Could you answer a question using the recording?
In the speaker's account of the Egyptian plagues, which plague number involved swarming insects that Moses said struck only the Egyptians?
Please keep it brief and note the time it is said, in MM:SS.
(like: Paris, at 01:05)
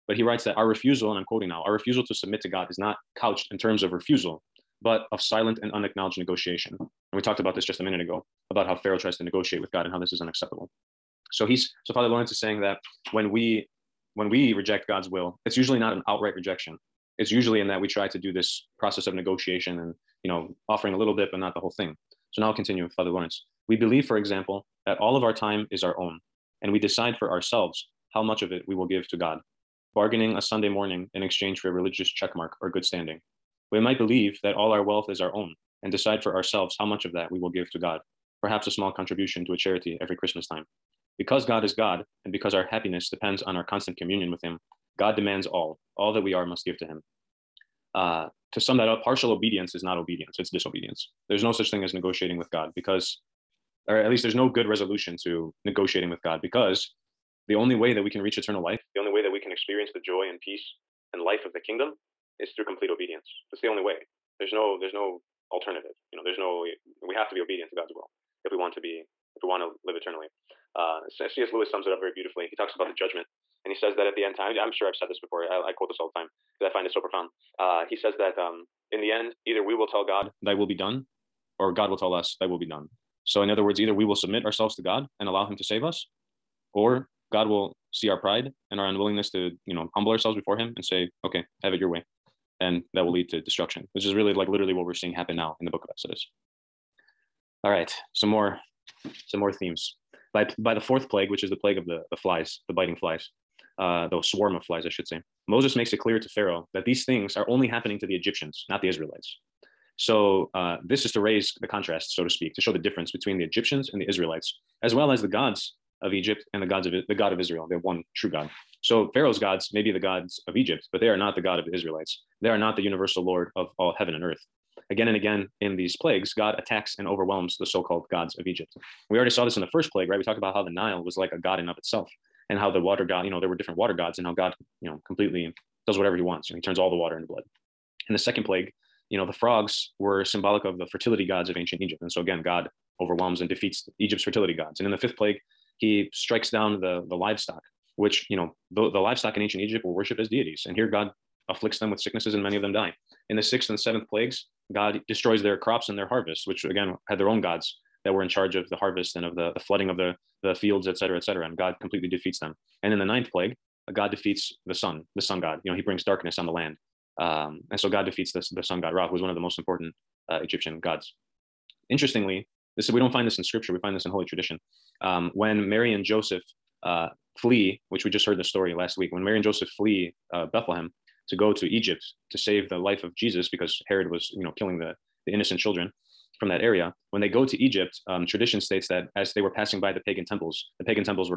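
4, at 01:40.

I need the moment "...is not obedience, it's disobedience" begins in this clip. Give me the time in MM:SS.
00:49.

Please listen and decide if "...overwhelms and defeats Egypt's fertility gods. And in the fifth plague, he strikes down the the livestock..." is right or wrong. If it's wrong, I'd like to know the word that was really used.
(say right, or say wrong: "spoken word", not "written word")
right.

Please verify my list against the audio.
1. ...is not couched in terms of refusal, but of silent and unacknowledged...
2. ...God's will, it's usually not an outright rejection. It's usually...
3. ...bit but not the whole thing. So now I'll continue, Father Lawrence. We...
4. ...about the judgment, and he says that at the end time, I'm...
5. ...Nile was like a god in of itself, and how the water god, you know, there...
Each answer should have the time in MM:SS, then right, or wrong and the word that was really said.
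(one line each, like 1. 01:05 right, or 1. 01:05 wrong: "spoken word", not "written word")
1. 00:02 right
2. 00:14 right
3. 00:21 right
4. 01:12 right
5. 02:10 right.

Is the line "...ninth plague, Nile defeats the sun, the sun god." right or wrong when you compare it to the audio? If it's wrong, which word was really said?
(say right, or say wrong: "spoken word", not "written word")
wrong: "God", not "Nile".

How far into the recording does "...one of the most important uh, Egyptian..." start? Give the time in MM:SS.
02:49.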